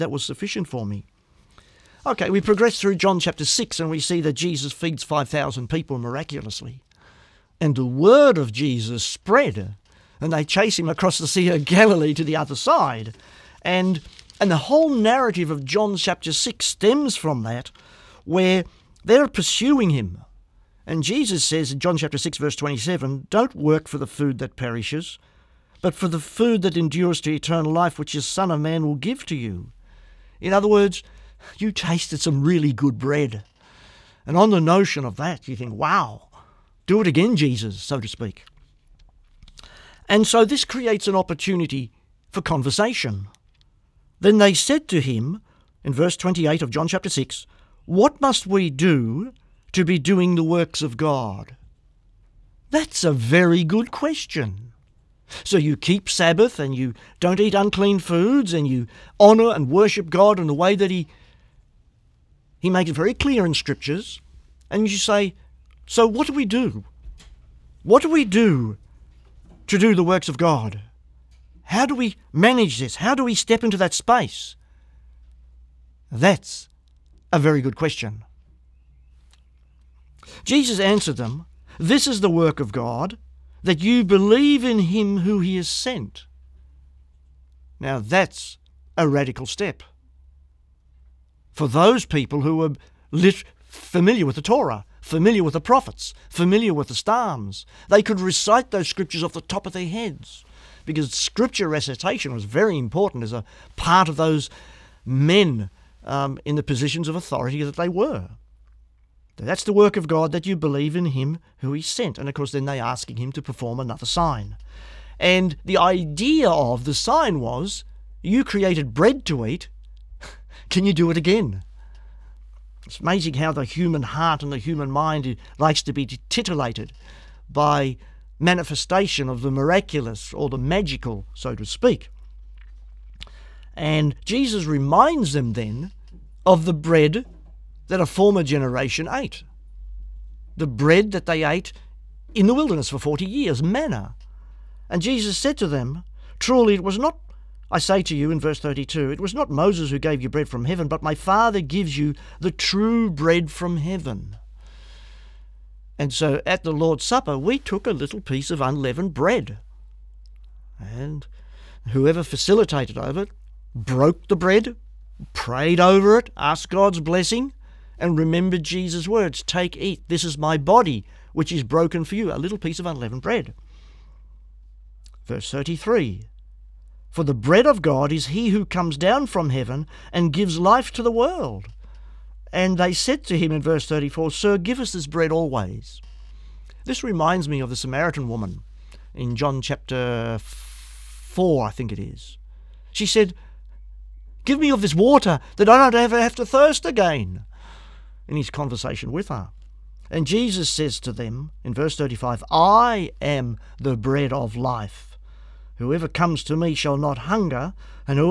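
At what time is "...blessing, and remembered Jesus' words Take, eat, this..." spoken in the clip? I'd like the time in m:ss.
2:47.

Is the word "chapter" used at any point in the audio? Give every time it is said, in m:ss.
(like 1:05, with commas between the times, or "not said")
0:03, 0:15, 0:21, 0:46, 3:09.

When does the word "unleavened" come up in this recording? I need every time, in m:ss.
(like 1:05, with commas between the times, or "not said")
2:38, 2:52.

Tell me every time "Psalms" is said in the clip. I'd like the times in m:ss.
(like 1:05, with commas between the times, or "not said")
1:36.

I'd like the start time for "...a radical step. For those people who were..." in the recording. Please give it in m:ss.
1:28.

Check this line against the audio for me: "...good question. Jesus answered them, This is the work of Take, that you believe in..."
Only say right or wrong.
wrong.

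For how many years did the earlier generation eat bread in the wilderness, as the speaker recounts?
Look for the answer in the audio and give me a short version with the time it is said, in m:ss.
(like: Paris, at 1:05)
40, at 2:22.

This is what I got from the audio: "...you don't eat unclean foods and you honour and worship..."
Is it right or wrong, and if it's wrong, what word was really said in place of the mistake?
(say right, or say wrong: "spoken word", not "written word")
right.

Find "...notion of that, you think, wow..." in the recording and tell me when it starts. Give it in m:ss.
0:34.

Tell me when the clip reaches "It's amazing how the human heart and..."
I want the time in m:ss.
2:02.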